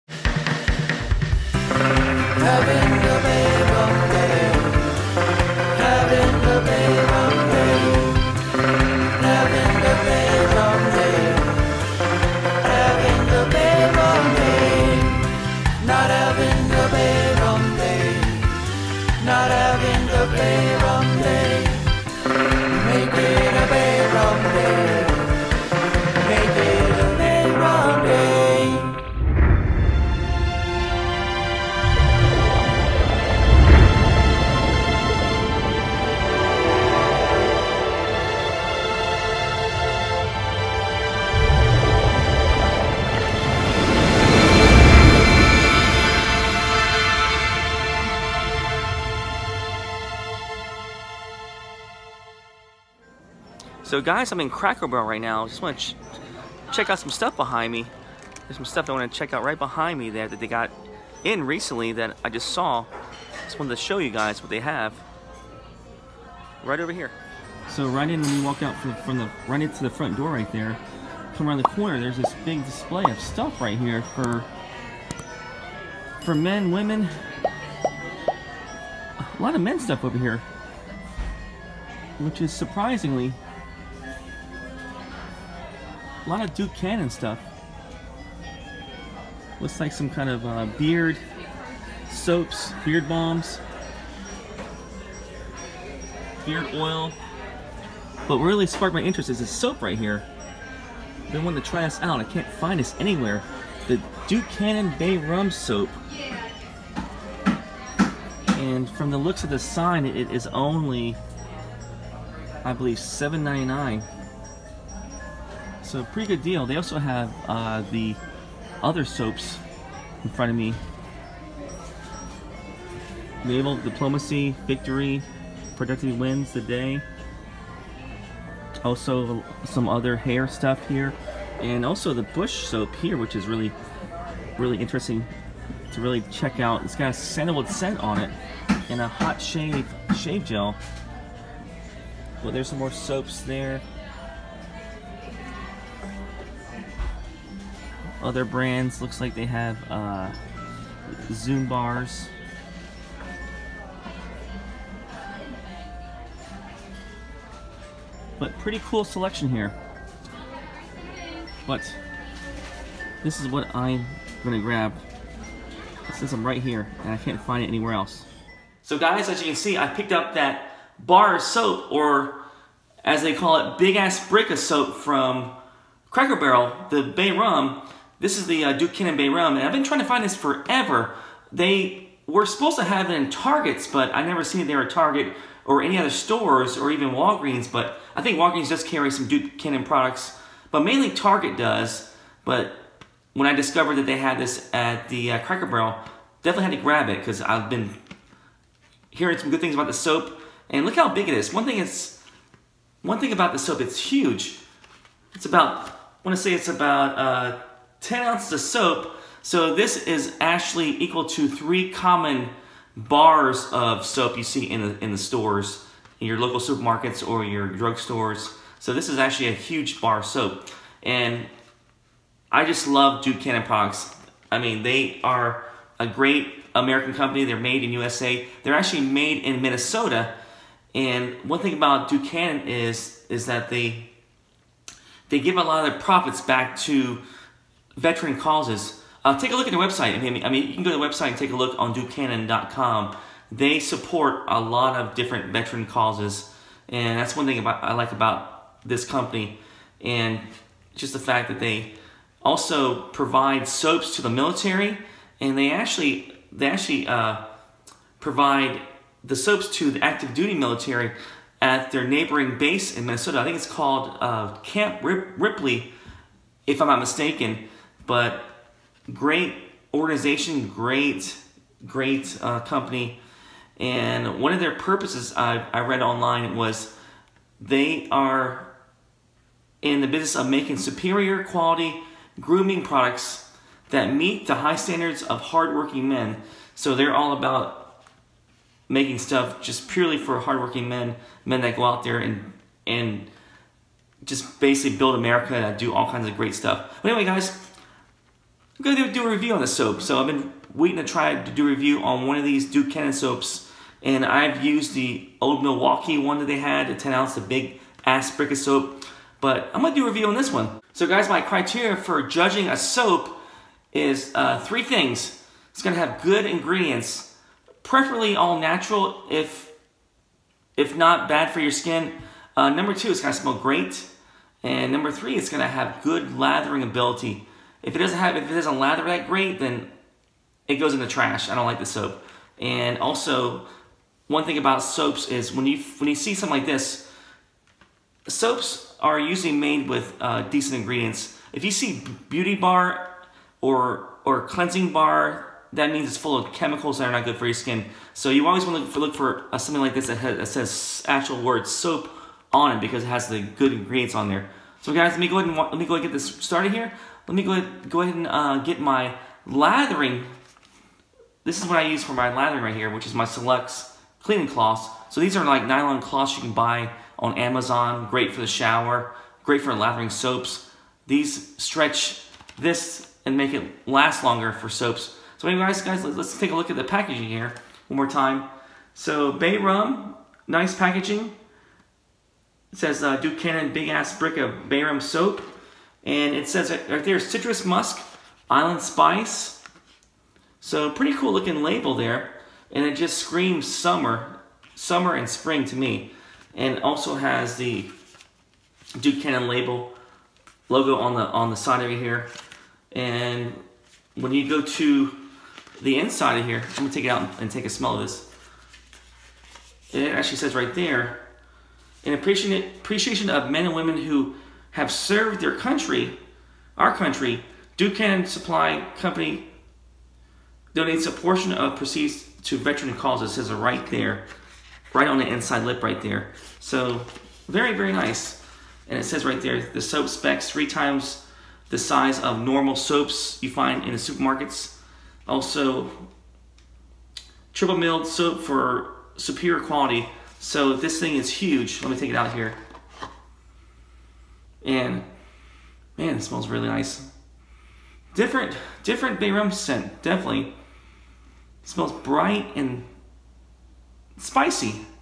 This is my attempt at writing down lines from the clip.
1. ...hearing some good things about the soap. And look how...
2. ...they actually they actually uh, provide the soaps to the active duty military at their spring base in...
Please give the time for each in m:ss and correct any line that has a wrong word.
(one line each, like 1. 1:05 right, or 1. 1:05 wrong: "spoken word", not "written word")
1. 3:19 right
2. 4:15 wrong: "neighboring", not "spring".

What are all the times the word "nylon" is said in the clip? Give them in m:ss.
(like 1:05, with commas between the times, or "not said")
6:05.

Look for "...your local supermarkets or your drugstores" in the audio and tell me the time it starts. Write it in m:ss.
3:36.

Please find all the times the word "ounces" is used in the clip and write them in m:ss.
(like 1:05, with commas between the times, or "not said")
3:28, 5:07.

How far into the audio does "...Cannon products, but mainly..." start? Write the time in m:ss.
3:09.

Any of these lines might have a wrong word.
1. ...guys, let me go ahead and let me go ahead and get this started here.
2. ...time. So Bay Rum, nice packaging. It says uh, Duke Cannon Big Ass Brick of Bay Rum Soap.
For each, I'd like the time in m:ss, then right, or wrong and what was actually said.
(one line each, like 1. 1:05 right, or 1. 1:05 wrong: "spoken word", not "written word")
1. 5:54 right
2. 6:18 right.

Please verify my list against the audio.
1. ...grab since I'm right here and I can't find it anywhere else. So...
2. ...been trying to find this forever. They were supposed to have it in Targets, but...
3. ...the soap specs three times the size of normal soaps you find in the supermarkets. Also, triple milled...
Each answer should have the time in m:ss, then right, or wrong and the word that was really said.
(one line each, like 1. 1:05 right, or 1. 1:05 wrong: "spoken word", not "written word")
1. 2:44 right
2. 2:59 right
3. 7:09 right.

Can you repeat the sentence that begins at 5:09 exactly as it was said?
But I'm going to do a review on this one.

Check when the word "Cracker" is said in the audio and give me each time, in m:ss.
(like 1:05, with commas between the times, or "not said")
0:54, 2:56, 3:15.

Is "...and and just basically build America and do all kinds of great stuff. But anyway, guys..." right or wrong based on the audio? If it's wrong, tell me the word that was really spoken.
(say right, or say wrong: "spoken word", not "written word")
right.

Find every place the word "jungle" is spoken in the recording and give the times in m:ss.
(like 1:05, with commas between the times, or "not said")
not said.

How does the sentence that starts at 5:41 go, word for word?
If you see beauty bar or or cleansing bar, that means it's full of chemicals that are not good for your skin.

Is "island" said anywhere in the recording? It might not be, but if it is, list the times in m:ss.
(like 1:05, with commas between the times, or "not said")
6:28.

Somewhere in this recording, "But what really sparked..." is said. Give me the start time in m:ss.
1:38.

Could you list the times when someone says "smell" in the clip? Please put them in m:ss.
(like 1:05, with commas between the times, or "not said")
5:23, 6:47, 7:26, 7:31.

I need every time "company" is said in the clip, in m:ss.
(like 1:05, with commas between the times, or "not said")
3:47, 4:09, 4:32, 6:58.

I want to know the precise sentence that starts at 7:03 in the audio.
It says it right there, right on the inside lip right there.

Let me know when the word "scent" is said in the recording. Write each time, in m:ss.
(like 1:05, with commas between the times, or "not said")
2:17, 7:29.